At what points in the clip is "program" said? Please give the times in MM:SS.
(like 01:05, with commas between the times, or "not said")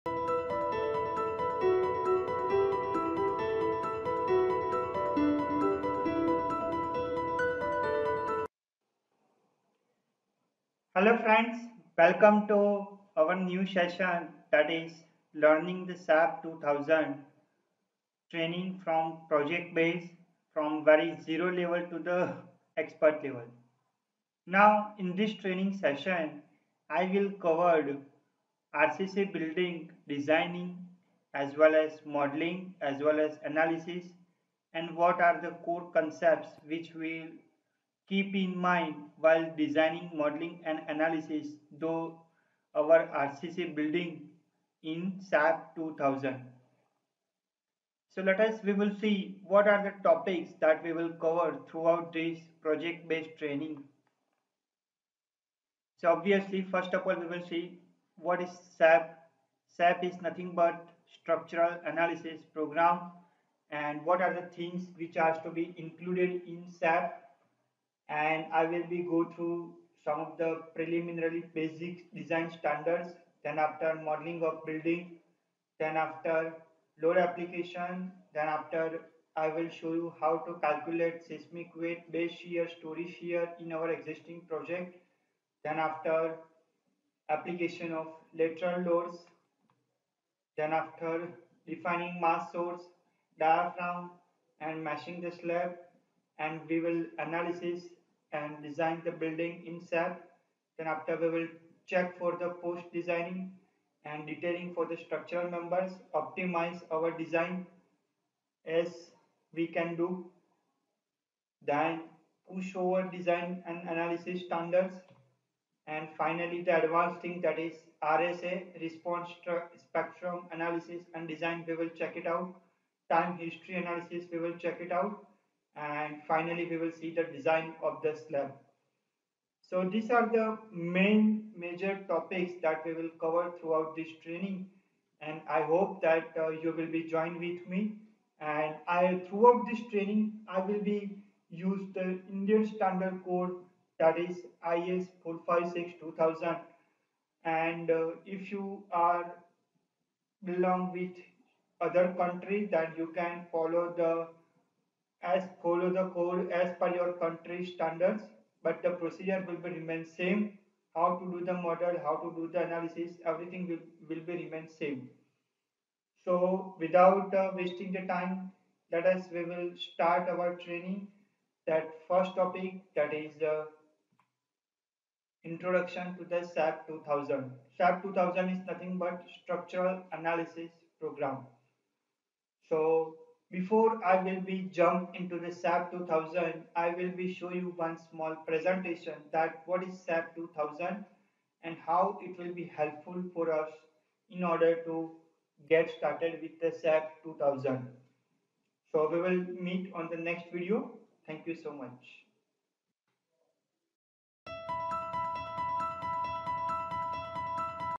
01:02, 03:00.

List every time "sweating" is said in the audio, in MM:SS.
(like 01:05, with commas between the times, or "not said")
not said.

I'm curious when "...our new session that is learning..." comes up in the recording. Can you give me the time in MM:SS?
00:13.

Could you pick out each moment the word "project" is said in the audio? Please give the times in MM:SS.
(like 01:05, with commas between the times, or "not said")
00:19, 00:52, 01:24.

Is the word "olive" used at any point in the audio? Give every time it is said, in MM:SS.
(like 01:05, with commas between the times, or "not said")
not said.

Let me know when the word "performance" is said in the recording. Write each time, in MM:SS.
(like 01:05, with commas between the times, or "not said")
not said.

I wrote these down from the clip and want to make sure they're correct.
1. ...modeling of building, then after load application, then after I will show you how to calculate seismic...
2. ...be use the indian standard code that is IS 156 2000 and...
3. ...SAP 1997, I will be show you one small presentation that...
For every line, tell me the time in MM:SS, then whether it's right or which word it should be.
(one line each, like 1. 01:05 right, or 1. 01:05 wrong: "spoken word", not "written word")
1. 01:14 right
2. 02:20 wrong: "456", not "156"
3. 03:05 wrong: "2000", not "1997".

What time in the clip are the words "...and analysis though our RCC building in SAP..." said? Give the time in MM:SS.
00:40.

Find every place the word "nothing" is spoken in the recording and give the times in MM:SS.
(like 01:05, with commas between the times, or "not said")
01:00, 02:58.